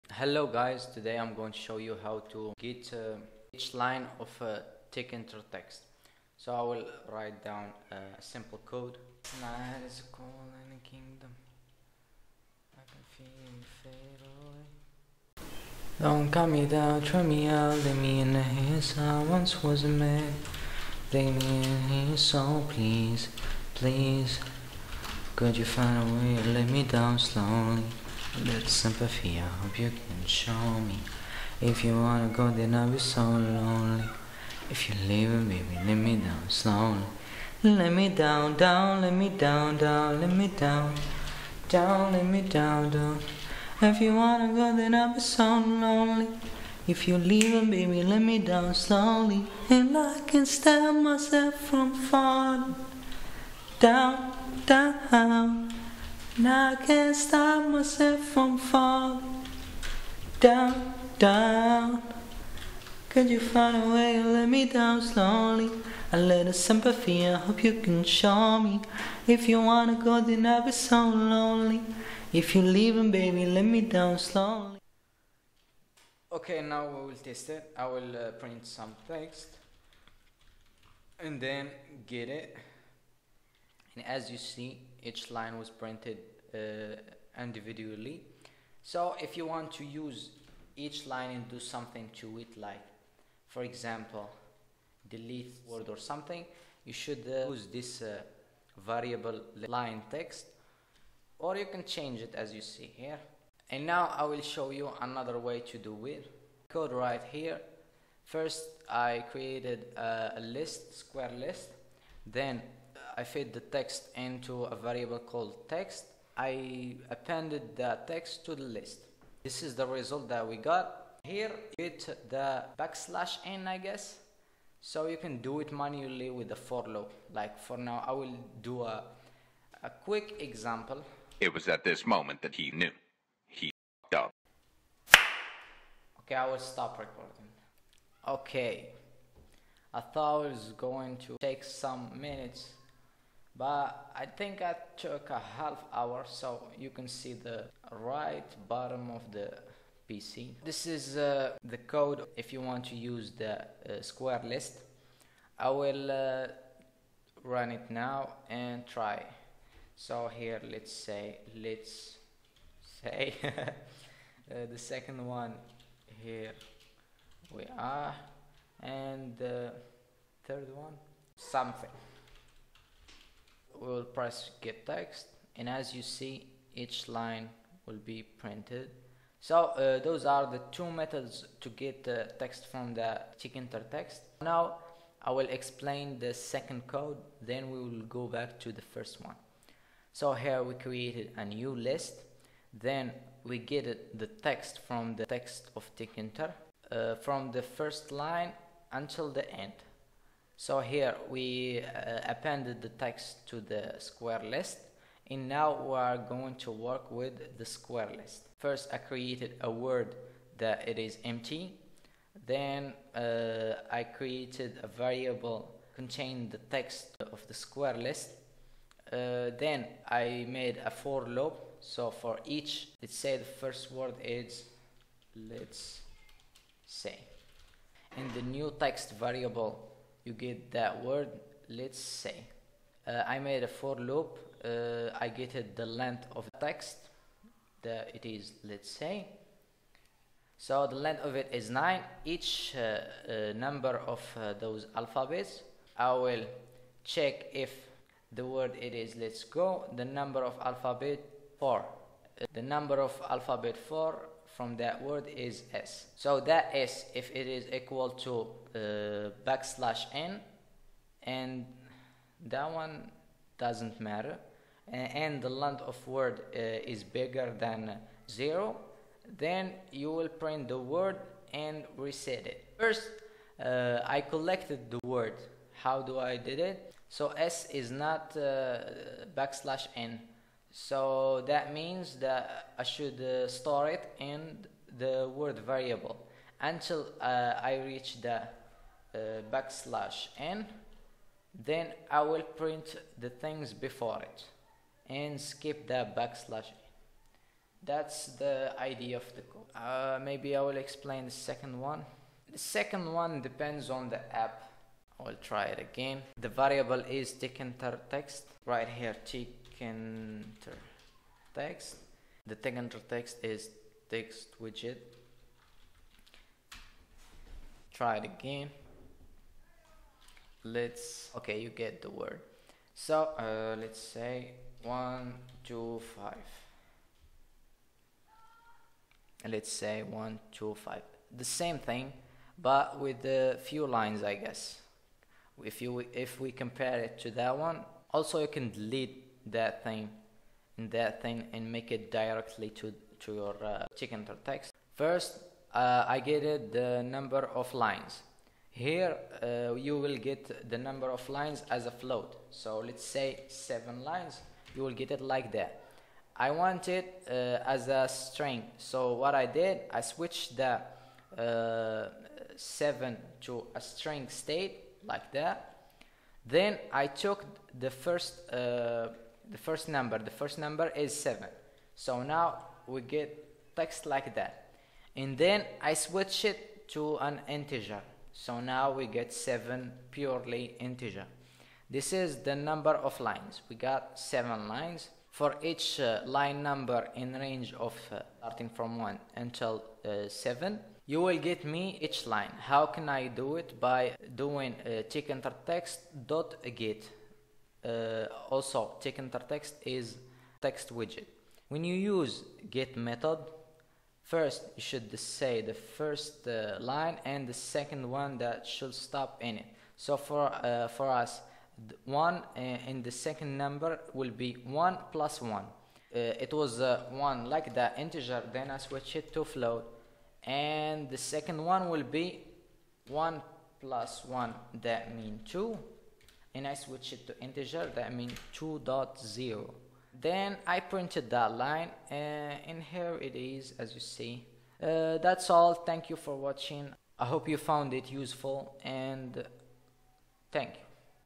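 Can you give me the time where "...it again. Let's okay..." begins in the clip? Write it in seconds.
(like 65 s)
318 s.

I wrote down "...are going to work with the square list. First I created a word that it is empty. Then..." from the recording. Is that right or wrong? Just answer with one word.
right.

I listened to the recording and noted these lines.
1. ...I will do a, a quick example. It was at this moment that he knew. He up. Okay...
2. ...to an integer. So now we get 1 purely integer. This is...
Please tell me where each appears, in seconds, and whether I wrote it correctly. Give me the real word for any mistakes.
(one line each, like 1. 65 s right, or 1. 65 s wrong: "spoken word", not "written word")
1. 128 s right
2. 376 s wrong: "7", not "1".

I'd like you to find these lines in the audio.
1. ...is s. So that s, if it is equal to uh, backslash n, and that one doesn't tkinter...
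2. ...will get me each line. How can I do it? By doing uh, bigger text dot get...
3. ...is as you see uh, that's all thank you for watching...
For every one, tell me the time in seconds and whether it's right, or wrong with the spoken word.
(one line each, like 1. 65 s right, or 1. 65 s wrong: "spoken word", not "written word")
1. 255 s wrong: "matter", not "tkinter"
2. 391 s wrong: "tkinter", not "bigger"
3. 433 s right.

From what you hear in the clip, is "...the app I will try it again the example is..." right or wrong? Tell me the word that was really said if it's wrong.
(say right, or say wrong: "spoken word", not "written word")
wrong: "variable", not "example".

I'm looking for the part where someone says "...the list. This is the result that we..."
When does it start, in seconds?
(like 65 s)
118 s.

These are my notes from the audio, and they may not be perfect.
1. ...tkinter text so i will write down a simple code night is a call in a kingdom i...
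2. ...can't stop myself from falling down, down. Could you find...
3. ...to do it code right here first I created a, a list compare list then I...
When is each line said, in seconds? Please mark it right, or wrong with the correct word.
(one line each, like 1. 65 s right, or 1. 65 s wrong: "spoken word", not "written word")
1. 4 s right
2. 56 s right
3. 105 s wrong: "square", not "compare".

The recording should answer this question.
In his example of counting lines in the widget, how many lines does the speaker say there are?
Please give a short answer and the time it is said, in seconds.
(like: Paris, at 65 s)
7, at 353 s.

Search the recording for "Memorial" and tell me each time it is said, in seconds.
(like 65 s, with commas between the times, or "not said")
not said.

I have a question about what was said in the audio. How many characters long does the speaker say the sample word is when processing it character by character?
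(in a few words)
9.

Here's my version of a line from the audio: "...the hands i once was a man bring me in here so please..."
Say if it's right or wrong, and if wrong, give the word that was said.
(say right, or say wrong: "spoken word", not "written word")
right.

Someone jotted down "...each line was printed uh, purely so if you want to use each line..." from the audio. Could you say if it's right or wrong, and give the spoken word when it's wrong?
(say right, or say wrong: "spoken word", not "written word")
wrong: "individually", not "purely".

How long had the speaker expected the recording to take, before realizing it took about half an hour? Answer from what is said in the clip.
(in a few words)
some minutes.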